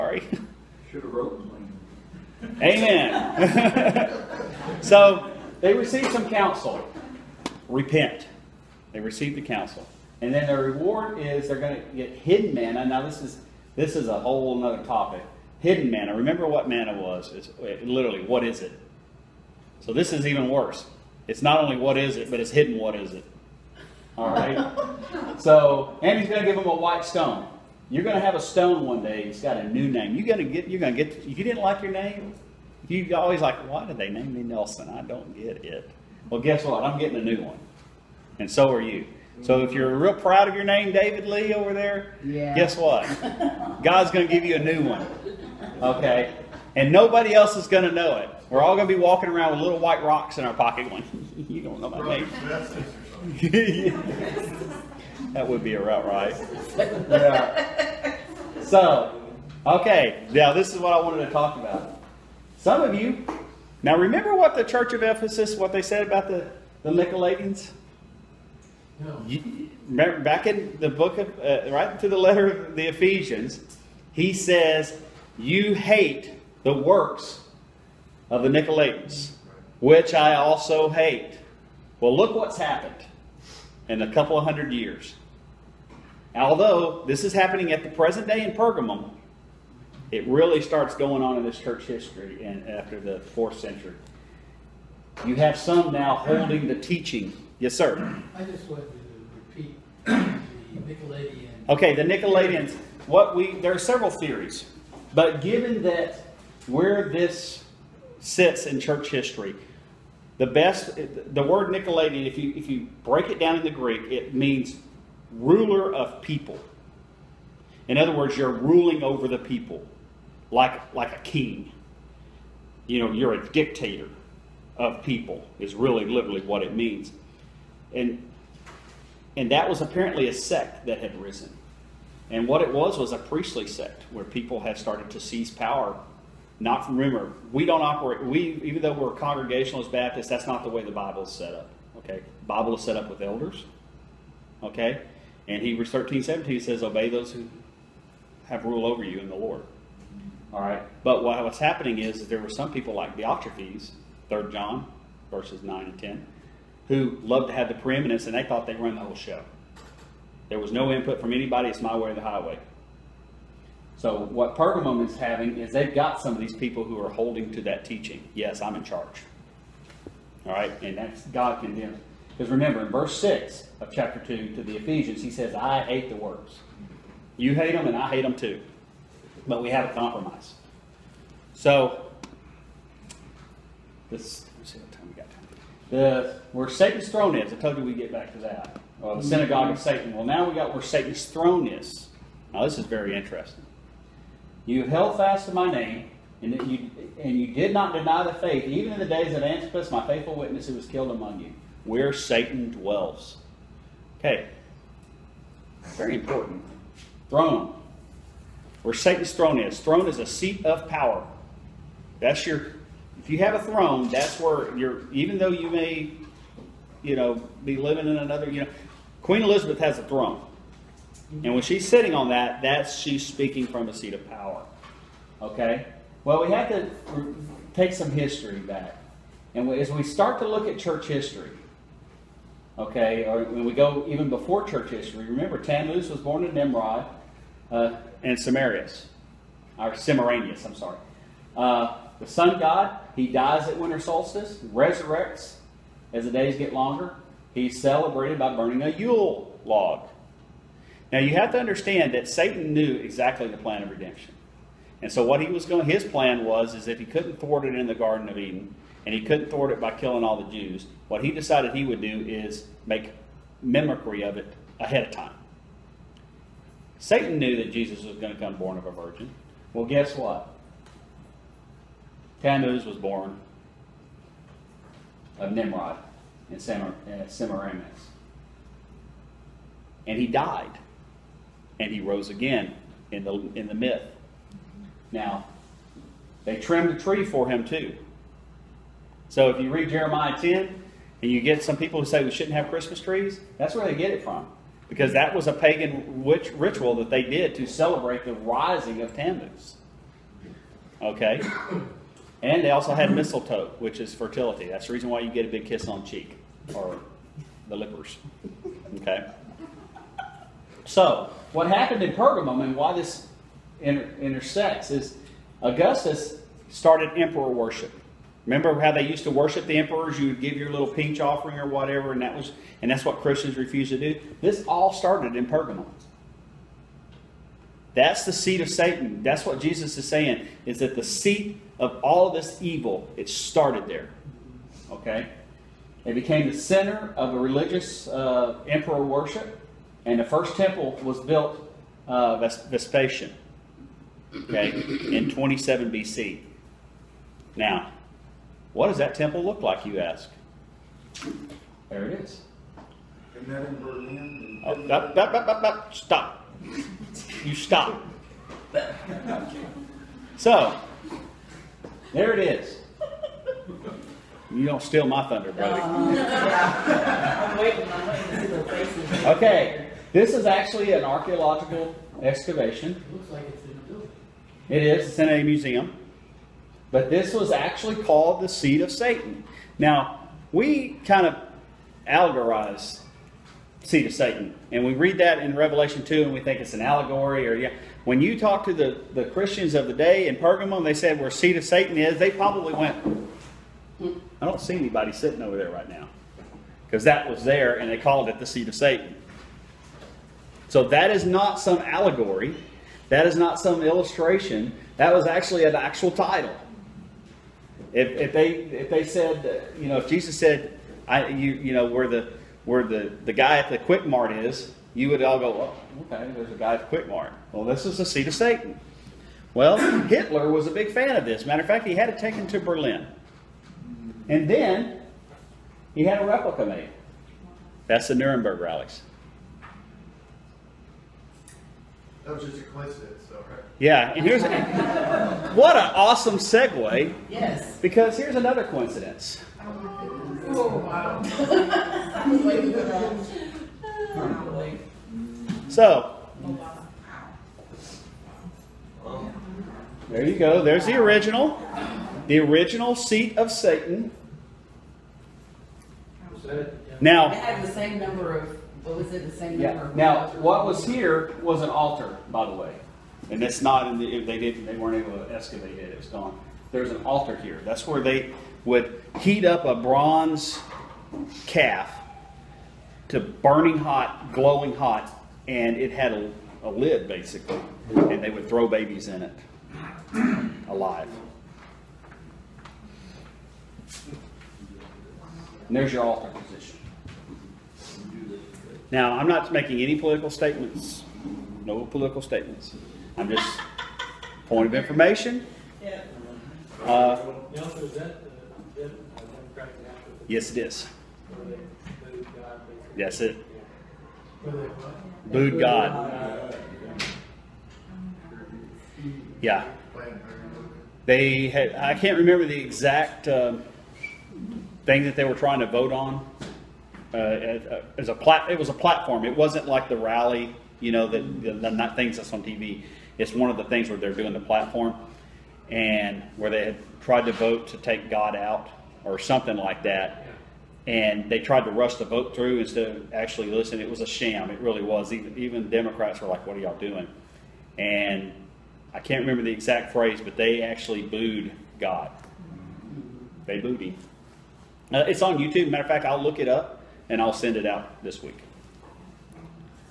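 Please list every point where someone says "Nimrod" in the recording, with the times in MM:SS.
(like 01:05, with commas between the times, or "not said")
03:56, 04:35.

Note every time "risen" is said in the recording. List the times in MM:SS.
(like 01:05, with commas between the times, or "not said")
02:11.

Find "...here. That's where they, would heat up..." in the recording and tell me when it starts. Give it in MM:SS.
07:47.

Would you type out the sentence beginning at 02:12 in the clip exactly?
And what it was was a priestly sect where people have started to seize power.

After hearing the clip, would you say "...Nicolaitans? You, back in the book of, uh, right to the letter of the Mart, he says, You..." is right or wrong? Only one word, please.
wrong.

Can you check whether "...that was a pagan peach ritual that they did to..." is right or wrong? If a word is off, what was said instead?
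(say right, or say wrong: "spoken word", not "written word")
wrong: "witch", not "peach".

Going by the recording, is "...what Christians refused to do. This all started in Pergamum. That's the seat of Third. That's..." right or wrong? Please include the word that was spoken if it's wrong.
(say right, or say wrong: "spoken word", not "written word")
wrong: "Satan", not "Third".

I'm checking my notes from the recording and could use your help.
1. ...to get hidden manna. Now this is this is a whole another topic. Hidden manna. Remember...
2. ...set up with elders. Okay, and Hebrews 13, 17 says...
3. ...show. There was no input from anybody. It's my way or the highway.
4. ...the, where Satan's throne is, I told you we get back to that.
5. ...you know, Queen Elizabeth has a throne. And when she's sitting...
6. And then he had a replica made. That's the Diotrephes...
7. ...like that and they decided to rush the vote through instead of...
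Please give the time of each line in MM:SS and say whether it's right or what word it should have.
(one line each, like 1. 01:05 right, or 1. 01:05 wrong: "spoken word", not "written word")
1. 00:11 right
2. 02:22 right
3. 02:39 right
4. 03:05 right
5. 03:38 right
6. 07:04 wrong: "Nuremberg", not "Diotrephes"
7. 08:49 wrong: "tried", not "decided".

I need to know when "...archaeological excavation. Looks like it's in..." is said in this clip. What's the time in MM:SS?
06:11.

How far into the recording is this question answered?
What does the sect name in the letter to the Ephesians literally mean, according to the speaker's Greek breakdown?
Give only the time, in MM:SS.
01:55.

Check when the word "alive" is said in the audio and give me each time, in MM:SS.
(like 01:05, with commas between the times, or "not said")
08:00.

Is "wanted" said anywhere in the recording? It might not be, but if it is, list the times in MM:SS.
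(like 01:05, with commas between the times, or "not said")
01:00, 01:38.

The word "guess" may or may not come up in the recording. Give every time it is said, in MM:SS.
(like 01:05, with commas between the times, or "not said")
00:36, 00:42, 04:29.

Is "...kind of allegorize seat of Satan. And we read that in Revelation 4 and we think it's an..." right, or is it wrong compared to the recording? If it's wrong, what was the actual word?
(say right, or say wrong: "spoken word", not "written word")
wrong: "2", not "4".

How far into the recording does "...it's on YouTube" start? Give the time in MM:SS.
09:05.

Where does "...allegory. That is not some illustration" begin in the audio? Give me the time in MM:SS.
06:41.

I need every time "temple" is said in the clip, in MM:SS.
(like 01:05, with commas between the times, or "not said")
05:40, 05:49.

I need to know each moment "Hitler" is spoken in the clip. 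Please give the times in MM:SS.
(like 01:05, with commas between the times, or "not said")
07:00.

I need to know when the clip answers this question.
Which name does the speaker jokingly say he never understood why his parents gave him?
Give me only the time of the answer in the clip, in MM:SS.
00:34.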